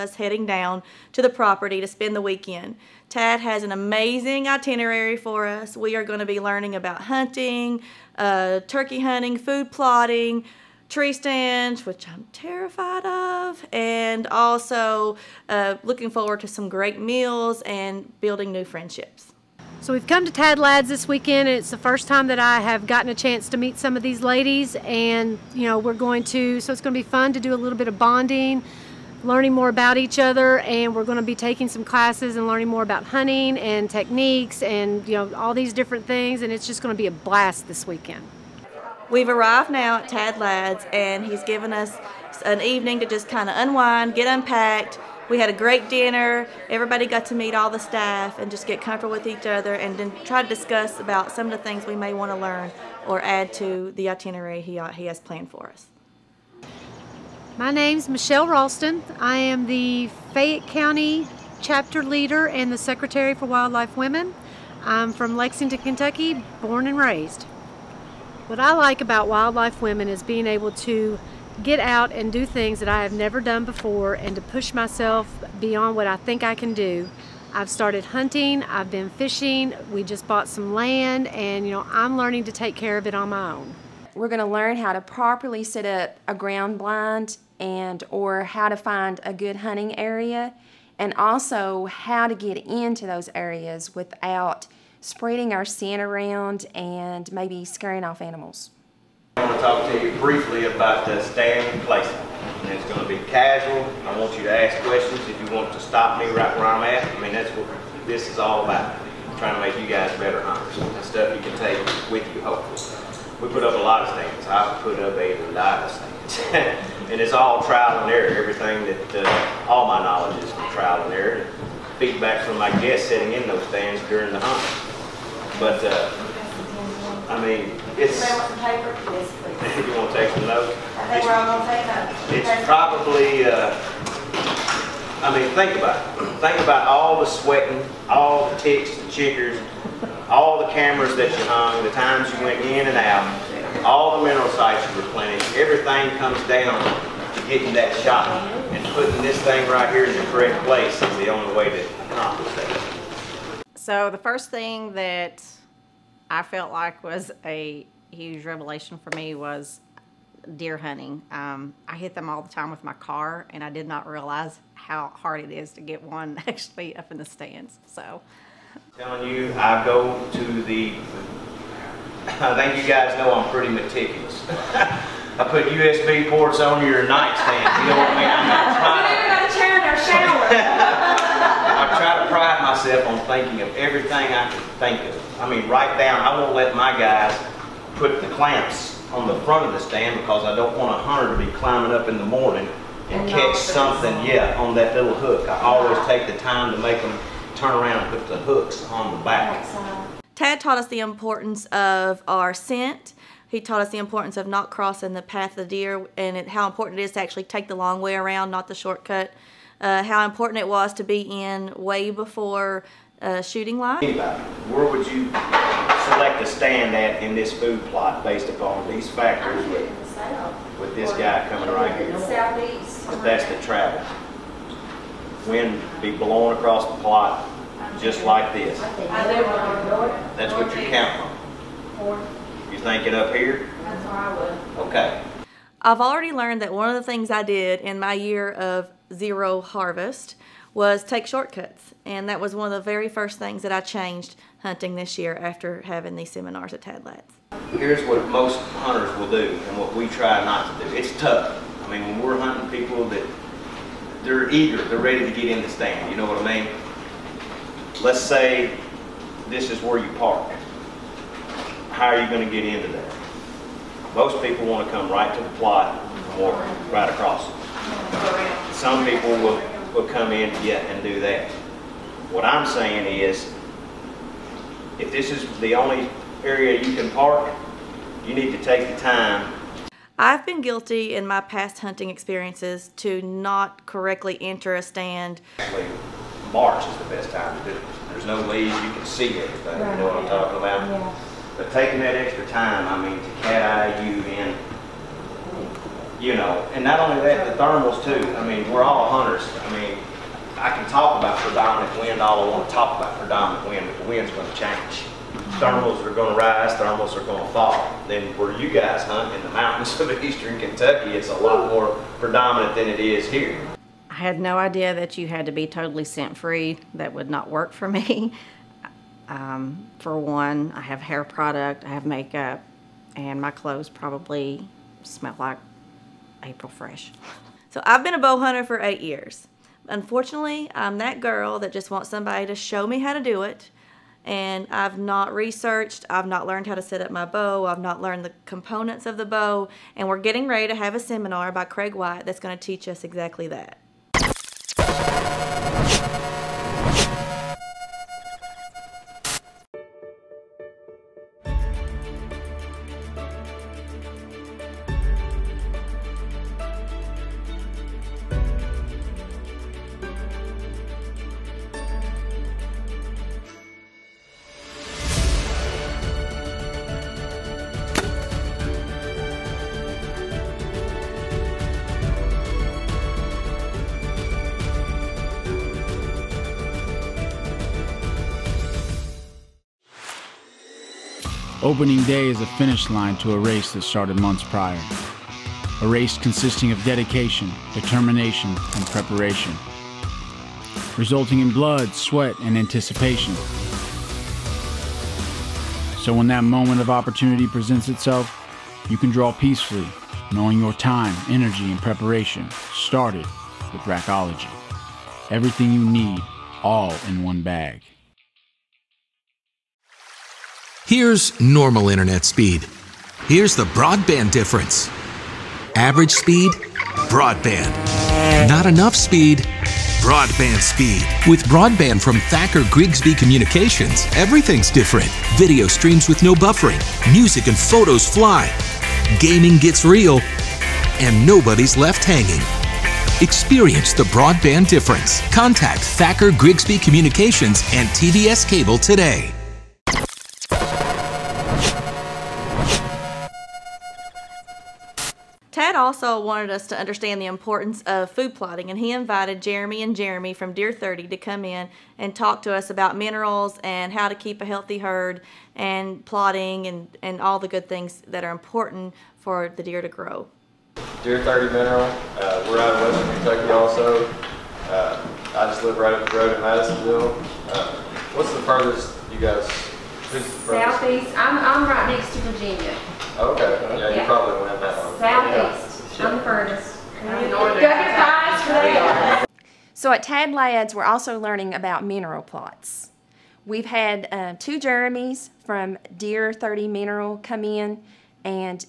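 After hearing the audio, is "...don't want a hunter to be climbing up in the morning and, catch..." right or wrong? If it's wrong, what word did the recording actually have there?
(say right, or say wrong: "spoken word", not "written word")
right.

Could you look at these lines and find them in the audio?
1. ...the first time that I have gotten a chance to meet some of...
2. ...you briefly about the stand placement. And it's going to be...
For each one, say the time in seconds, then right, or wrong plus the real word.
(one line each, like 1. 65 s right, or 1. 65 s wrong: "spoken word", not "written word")
1. 21 s right
2. 100 s right.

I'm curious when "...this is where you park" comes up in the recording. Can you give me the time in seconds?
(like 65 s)
259 s.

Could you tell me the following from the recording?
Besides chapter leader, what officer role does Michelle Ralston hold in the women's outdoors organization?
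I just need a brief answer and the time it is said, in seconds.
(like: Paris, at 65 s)
Secretary, at 62 s.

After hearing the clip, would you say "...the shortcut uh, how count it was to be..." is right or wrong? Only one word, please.
wrong.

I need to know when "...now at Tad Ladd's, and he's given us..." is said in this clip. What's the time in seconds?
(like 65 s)
39 s.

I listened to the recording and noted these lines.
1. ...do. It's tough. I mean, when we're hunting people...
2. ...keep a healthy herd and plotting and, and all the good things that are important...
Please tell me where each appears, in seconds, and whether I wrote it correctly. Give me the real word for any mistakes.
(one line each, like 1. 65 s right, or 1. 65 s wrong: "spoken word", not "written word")
1. 250 s right
2. 454 s right.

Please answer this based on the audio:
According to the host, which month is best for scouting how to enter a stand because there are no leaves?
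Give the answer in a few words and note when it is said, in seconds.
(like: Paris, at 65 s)
March, at 286 s.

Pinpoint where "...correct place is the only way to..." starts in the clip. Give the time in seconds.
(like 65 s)
150 s.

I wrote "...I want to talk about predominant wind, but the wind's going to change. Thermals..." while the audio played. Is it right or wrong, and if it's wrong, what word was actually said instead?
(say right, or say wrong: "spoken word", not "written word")
right.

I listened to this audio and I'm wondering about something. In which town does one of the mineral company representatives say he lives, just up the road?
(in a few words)
Madisonville.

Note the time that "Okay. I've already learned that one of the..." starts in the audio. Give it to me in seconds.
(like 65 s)
234 s.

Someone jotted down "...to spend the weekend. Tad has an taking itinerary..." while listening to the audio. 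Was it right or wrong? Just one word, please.
wrong.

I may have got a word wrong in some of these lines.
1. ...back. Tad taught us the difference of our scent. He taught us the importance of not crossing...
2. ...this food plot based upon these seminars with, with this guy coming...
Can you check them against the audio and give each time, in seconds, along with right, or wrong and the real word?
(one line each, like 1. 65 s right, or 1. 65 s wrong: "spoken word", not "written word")
1. 199 s wrong: "importance", not "difference"
2. 217 s wrong: "factors", not "seminars".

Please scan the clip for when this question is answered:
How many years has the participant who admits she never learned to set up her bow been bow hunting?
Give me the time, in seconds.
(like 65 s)
328 s.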